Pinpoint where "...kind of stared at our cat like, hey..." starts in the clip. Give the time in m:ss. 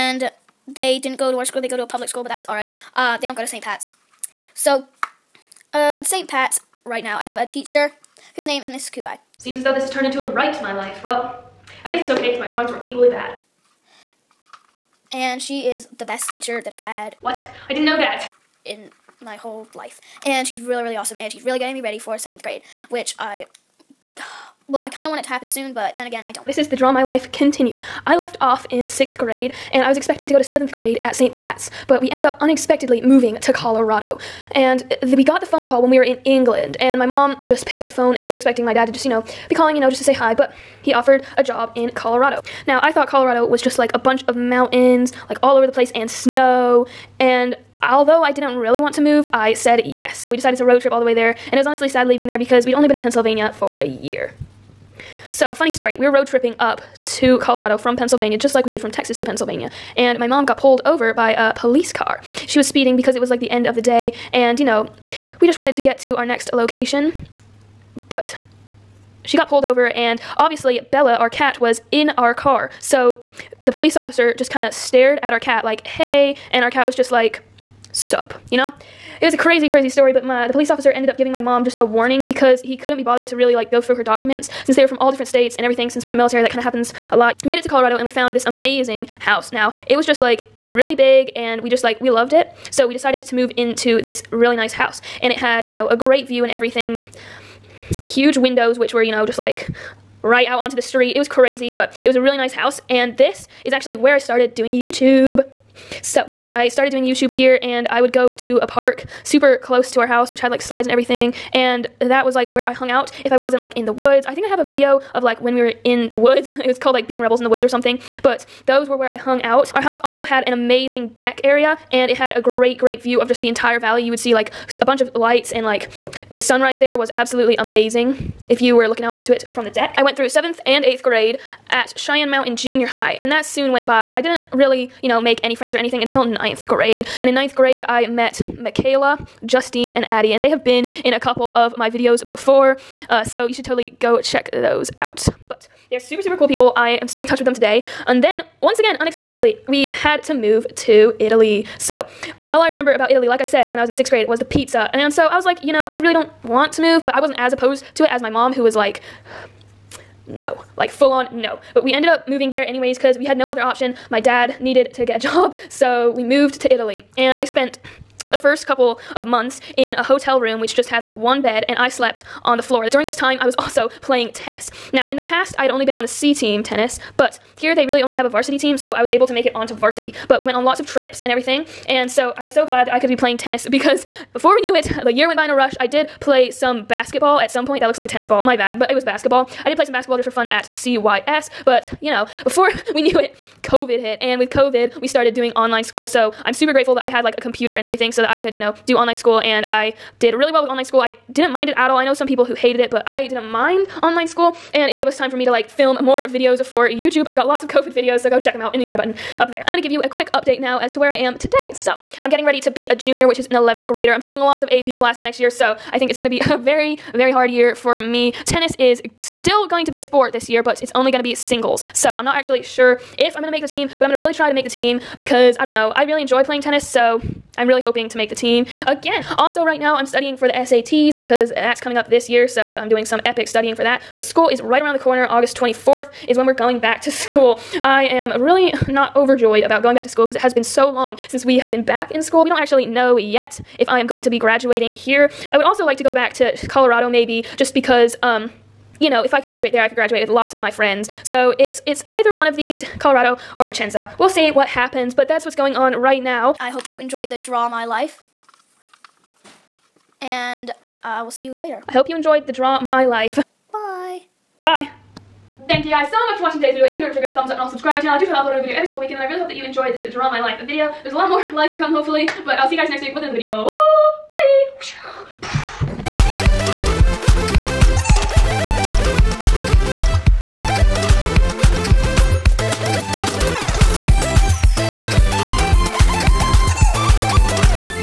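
1:14.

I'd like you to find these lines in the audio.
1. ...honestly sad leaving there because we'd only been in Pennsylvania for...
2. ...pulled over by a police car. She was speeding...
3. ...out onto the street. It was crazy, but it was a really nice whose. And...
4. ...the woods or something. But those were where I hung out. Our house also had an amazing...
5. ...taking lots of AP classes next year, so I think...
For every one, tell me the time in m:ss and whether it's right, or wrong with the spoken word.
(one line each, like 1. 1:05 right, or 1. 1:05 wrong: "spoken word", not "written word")
1. 0:51 right
2. 1:00 right
3. 1:40 wrong: "house", not "whose"
4. 1:57 right
5. 3:34 right.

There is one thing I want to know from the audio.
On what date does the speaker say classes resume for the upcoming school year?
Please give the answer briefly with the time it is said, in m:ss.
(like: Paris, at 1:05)
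August 24th, at 3:55.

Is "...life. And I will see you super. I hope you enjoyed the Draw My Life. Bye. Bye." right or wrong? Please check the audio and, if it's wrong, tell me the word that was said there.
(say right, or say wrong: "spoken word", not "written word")
wrong: "later", not "super".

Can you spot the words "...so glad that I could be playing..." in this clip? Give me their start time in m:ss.
3:02.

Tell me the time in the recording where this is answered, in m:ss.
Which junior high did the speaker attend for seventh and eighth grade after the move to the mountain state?
2:11.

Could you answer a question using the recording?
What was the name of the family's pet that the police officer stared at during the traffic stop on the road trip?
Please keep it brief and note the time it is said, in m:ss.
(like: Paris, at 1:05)
Bella, at 1:10.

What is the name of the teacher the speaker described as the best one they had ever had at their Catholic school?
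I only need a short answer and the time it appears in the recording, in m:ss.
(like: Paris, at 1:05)
Miss Kugai, at 0:08.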